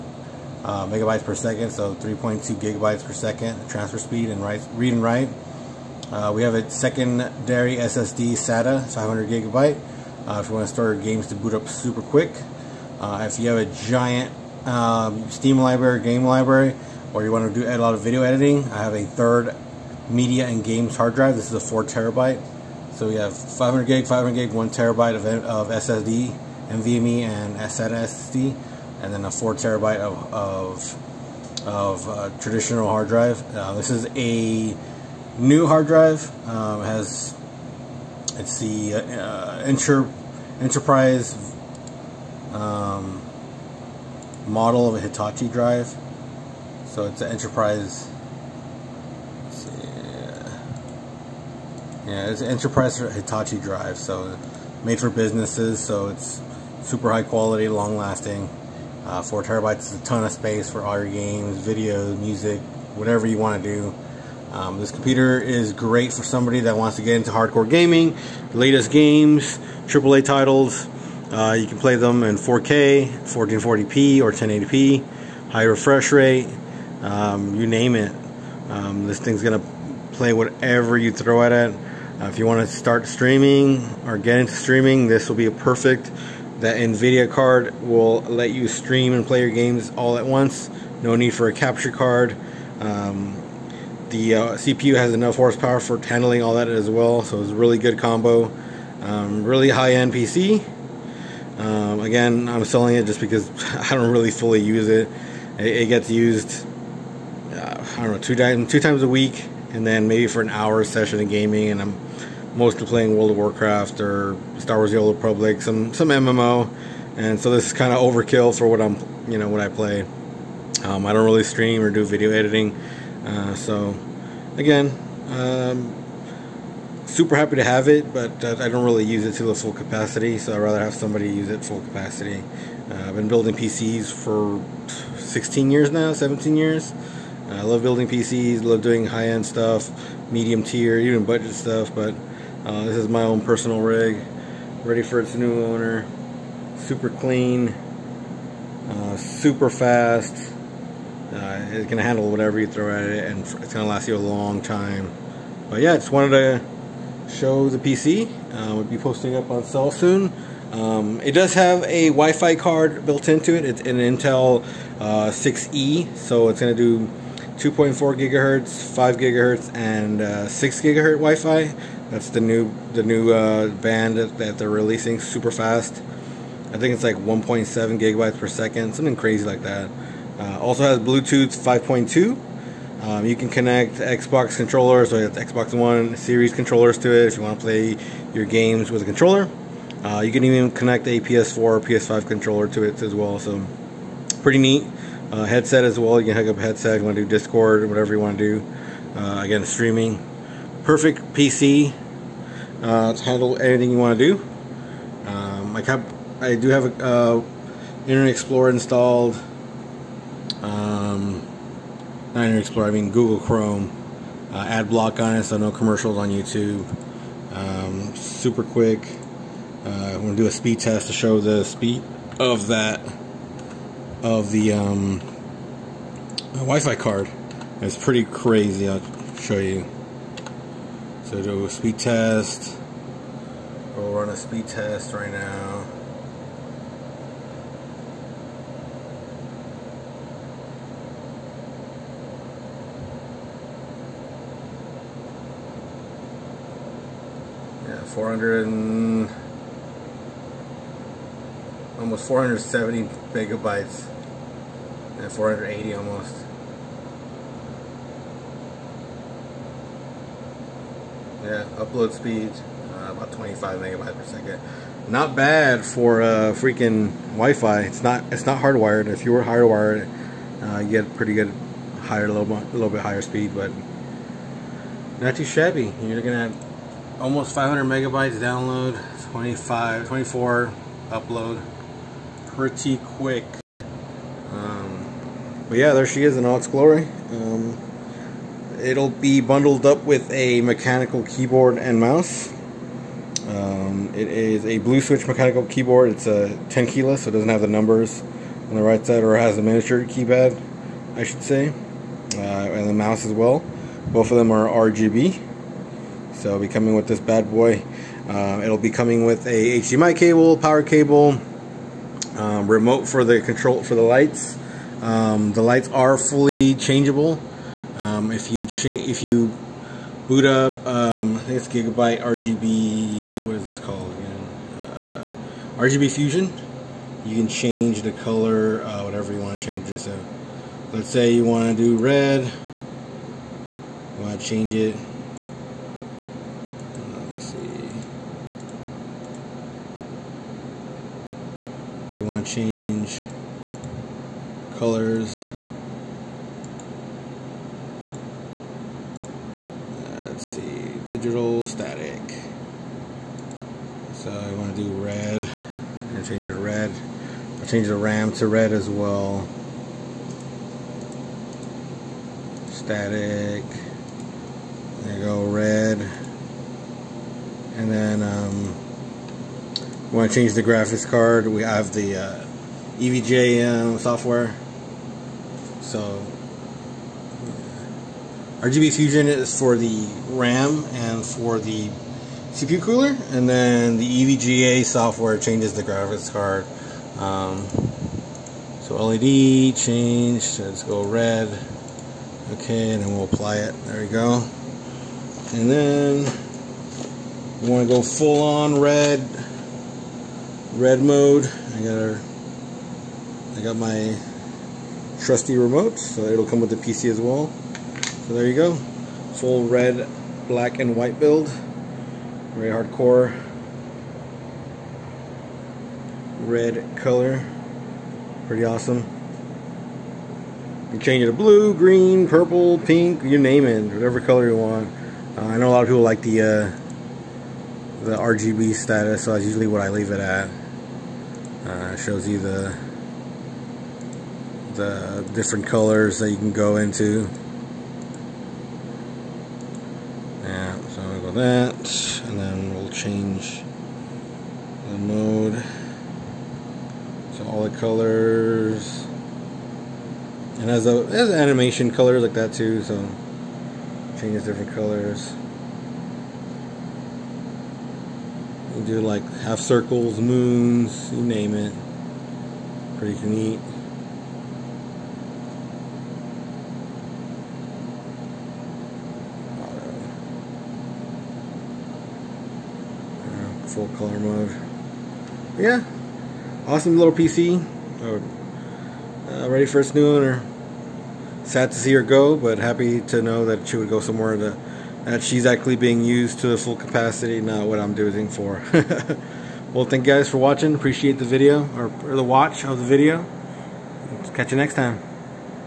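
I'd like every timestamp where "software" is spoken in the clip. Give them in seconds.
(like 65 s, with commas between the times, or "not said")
373 s, 384 s.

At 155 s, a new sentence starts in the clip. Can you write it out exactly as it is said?
But yeah, just wanted to show the PC.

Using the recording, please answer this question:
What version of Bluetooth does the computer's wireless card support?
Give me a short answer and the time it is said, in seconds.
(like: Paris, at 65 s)
5.2, at 180 s.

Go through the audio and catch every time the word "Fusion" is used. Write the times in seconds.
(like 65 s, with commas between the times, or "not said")
326 s, 378 s.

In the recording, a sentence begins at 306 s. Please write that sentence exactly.
So it'll be coming with this bad boy.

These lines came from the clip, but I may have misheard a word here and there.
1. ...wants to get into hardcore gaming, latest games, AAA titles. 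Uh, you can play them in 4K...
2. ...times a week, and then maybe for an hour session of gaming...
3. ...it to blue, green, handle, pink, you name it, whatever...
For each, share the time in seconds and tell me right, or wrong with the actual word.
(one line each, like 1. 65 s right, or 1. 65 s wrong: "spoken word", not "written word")
1. 66 s right
2. 108 s right
3. 421 s wrong: "purple", not "handle".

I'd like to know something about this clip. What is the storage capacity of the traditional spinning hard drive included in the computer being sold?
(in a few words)
4 terabytes.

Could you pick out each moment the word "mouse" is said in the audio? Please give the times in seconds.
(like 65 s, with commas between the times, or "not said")
291 s, 302 s.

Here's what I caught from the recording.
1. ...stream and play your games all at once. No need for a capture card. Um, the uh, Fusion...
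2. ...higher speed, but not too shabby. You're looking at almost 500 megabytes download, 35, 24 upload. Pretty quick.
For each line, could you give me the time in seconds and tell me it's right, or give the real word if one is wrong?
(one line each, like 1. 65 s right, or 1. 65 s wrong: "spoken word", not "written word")
1. 88 s wrong: "CPU", not "Fusion"
2. 272 s wrong: "25", not "35".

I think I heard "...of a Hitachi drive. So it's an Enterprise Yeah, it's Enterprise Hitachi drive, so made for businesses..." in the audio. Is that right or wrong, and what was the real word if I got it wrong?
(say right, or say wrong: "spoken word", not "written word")
right.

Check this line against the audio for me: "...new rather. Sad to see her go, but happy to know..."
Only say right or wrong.
wrong.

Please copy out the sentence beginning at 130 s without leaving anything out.
So I'd rather have somebody use it full capacity.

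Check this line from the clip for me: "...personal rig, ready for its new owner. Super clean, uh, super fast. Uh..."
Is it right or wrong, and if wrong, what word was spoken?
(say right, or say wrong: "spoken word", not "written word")
right.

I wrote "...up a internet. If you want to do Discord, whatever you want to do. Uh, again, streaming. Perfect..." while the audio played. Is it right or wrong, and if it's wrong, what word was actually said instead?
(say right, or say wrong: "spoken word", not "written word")
wrong: "headset", not "internet".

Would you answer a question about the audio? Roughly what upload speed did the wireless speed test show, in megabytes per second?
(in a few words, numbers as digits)
25.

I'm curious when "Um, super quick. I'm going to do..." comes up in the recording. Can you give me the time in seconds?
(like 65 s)
217 s.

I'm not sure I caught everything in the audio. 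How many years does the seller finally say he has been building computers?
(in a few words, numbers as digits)
17 years.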